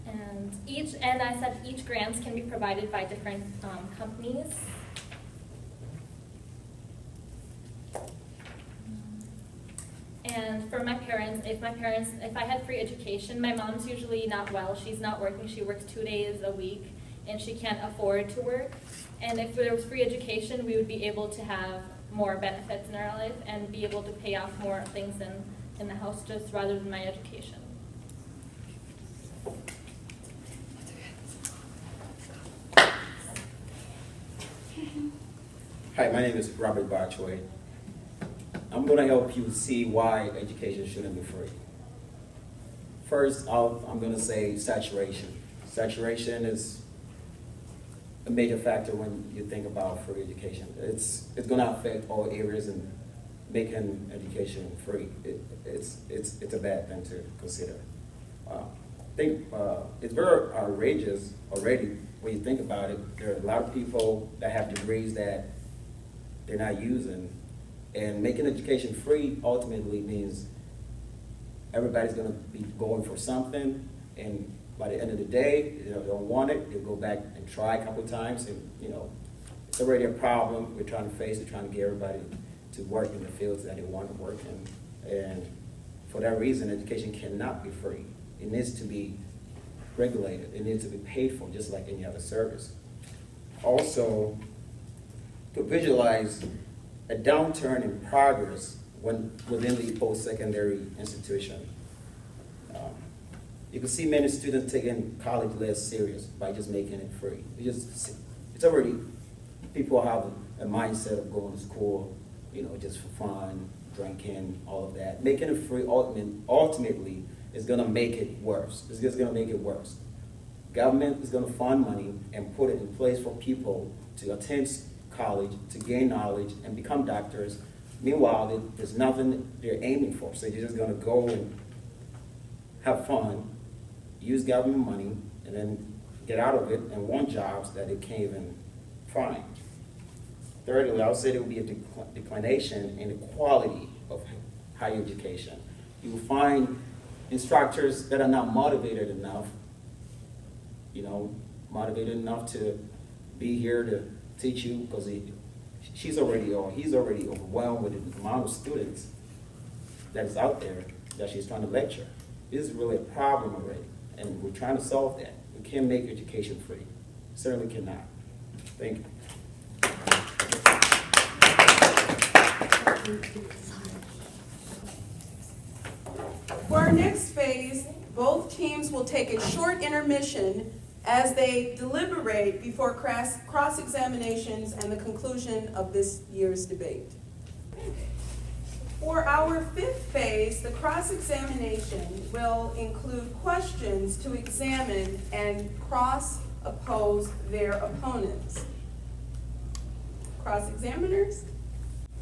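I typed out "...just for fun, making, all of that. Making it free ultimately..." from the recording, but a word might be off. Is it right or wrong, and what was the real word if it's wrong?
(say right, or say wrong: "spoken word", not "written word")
wrong: "drinking", not "making".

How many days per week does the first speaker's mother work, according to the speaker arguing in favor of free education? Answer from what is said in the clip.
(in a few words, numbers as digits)
2.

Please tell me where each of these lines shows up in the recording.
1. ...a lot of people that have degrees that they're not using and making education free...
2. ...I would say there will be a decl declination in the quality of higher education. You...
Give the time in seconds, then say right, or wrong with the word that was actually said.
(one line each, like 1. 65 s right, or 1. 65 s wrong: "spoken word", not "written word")
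1. 63 s right
2. 141 s right.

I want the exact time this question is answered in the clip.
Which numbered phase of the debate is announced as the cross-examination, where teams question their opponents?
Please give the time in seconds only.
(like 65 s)
189 s.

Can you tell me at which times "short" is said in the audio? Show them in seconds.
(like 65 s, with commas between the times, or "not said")
179 s.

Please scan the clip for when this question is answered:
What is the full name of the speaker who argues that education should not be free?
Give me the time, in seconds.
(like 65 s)
36 s.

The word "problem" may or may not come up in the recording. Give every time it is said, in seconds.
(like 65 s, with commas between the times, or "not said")
80 s, 163 s.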